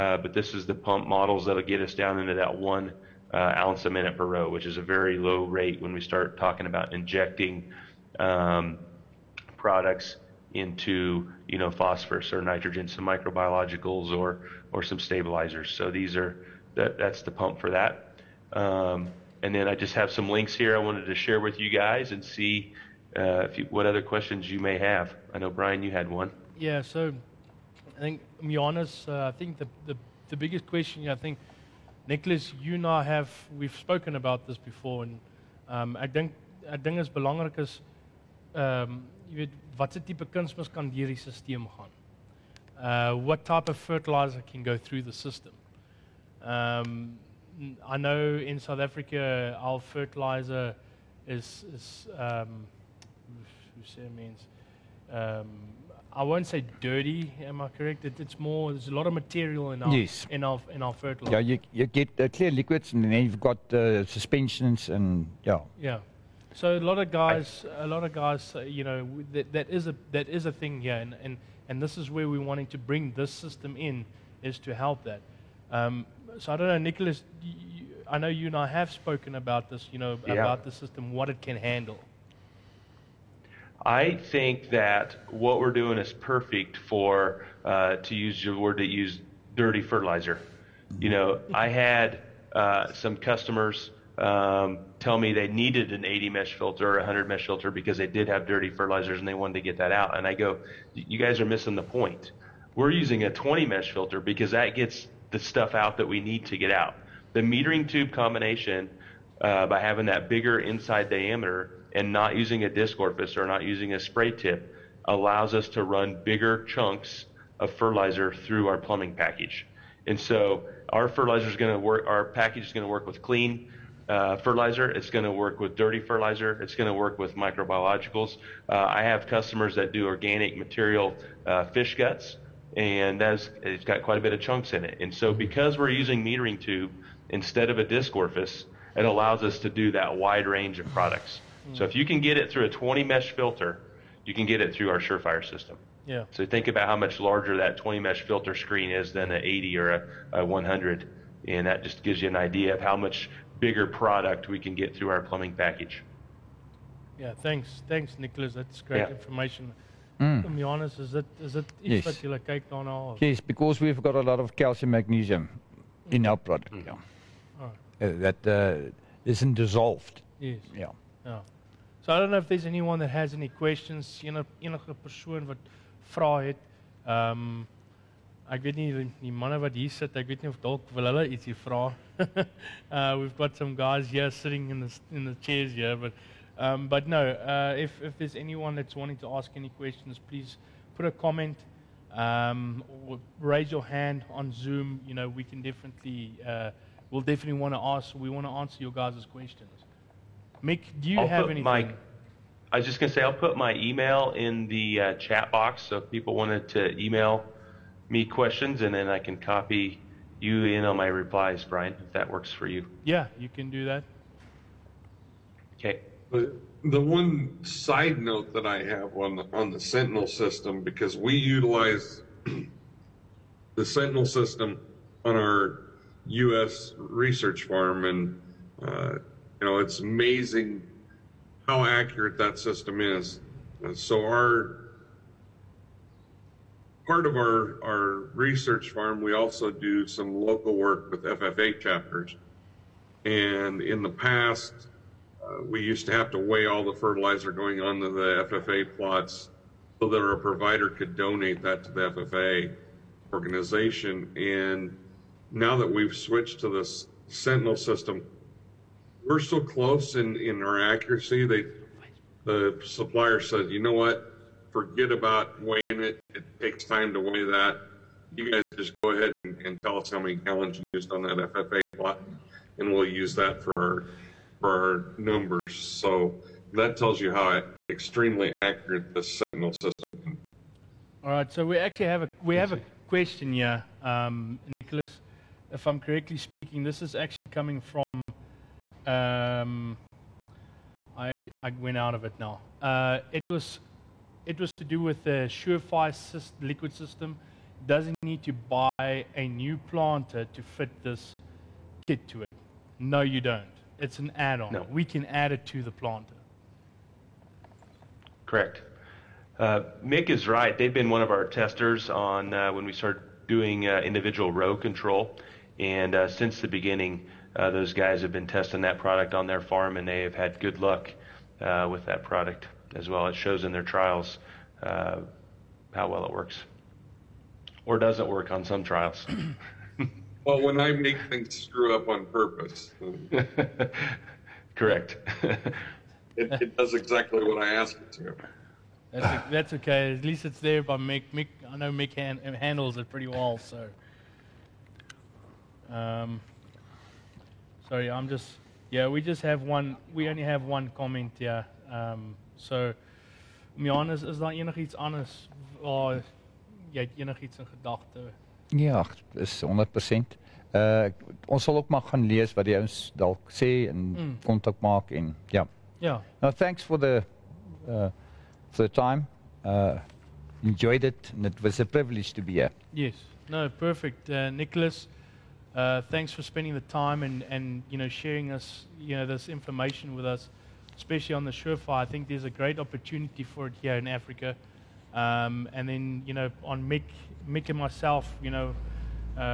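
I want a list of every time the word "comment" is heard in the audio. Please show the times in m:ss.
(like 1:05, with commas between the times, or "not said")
3:11, 5:50.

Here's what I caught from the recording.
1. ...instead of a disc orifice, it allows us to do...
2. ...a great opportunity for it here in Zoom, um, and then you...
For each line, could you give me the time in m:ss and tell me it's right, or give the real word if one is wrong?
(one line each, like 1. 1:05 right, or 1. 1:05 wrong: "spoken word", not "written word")
1. 2:17 right
2. 6:22 wrong: "Africa", not "Zoom".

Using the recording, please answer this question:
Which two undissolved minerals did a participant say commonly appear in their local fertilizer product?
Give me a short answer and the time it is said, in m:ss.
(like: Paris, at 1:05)
calcium magnesium, at 2:44.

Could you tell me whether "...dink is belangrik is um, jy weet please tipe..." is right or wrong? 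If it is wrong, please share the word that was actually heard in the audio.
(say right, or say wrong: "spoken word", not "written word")
wrong: "watse", not "please".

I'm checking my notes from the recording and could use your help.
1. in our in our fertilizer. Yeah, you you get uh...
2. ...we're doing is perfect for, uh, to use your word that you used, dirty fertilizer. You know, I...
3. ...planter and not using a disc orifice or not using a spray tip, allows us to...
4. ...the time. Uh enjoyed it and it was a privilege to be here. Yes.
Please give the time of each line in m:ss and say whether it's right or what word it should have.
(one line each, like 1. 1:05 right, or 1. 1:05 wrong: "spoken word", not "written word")
1. 1:00 right
2. 1:25 right
3. 1:51 wrong: "diameter", not "planter"
4. 6:08 right.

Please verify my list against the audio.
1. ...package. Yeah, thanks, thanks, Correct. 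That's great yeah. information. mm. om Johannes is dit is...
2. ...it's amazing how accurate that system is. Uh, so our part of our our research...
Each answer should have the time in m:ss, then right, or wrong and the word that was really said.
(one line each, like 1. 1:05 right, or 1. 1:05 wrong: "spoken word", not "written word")
1. 2:35 wrong: "Nicholas", not "Correct"
2. 3:49 right.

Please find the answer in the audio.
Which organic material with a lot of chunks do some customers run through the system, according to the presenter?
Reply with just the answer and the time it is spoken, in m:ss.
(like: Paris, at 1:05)
fish guts, at 2:11.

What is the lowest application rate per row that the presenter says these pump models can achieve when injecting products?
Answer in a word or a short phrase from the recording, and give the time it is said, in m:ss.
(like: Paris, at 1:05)
1 ounce a minute, at 0:02.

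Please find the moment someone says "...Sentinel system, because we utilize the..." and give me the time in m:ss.
3:39.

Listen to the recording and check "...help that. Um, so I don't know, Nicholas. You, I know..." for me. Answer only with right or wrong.
right.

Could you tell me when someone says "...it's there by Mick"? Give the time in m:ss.
5:40.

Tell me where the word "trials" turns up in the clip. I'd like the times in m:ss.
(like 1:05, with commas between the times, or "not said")
5:23, 5:28.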